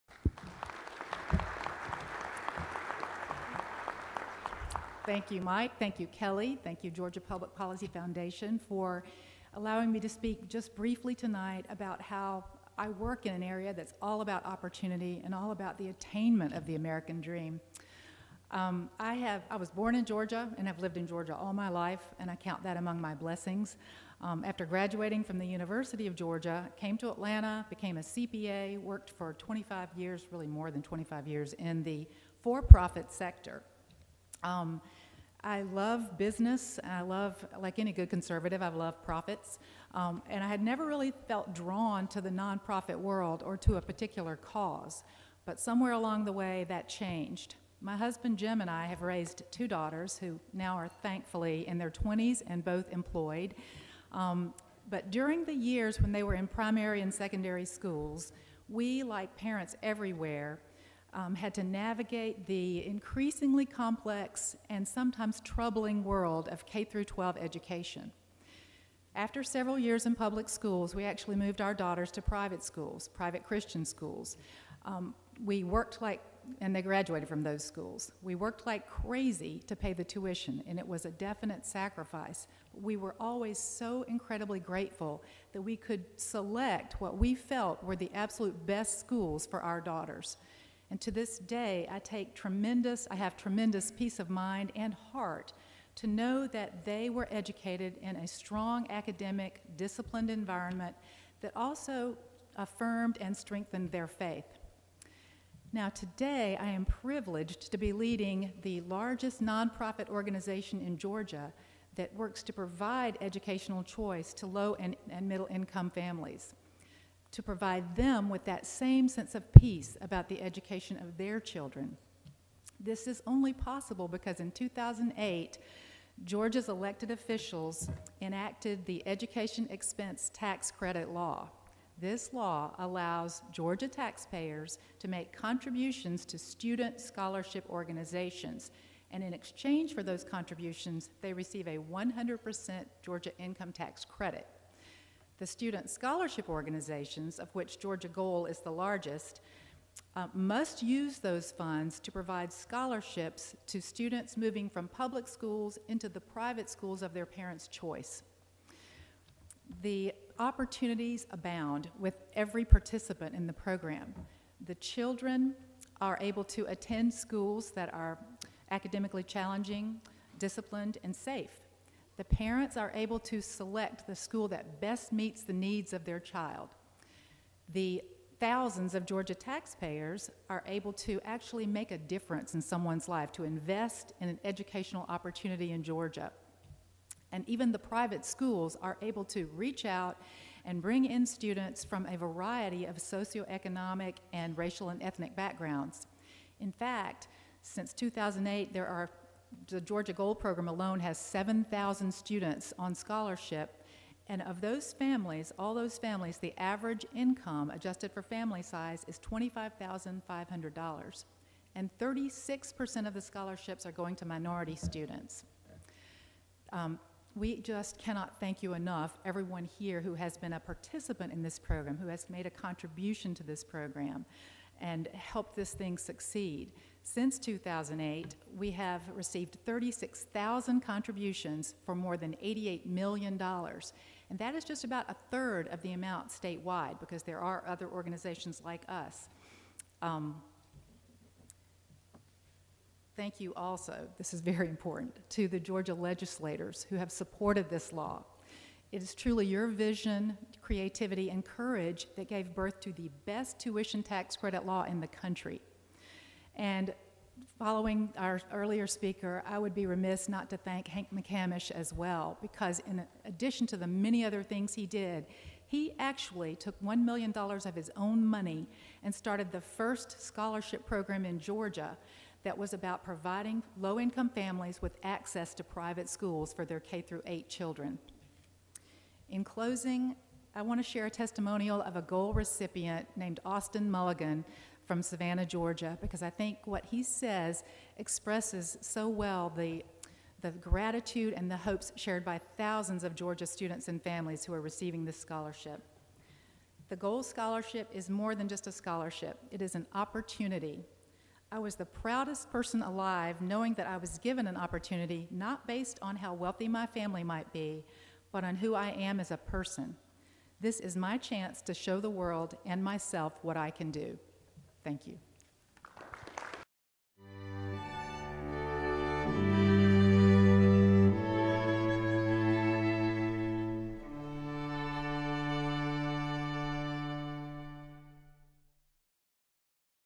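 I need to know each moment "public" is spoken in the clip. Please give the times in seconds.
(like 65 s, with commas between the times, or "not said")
7 s, 70 s, 154 s.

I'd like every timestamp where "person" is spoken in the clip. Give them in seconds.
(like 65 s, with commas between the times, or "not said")
302 s, 309 s.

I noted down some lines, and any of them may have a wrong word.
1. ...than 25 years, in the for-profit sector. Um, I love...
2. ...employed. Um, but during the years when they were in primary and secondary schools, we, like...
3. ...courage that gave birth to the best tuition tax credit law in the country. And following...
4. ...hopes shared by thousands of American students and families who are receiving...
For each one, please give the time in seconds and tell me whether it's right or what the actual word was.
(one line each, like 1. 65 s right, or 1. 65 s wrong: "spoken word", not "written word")
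1. 30 s right
2. 52 s right
3. 251 s right
4. 291 s wrong: "Georgia", not "American".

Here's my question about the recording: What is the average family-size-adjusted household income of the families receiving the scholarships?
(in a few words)
$25,500.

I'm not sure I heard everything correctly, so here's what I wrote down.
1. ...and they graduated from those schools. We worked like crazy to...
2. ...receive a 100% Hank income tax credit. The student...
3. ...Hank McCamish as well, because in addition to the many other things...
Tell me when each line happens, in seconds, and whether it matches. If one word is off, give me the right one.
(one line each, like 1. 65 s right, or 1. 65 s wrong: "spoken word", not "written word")
1. 76 s right
2. 141 s wrong: "Georgia", not "Hank"
3. 260 s right.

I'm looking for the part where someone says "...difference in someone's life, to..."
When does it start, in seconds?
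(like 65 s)
181 s.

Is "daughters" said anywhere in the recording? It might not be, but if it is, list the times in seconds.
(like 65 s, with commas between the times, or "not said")
49 s, 71 s, 89 s.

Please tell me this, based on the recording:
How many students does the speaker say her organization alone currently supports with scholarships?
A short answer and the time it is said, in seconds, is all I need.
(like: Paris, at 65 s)
7,000, at 201 s.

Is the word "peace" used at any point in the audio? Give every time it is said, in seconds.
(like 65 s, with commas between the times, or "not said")
93 s, 119 s.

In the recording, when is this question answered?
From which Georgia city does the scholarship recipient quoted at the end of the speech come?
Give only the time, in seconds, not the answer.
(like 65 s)
285 s.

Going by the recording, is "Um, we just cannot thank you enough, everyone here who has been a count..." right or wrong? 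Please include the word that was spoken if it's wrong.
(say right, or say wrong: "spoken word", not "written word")
wrong: "participant", not "count".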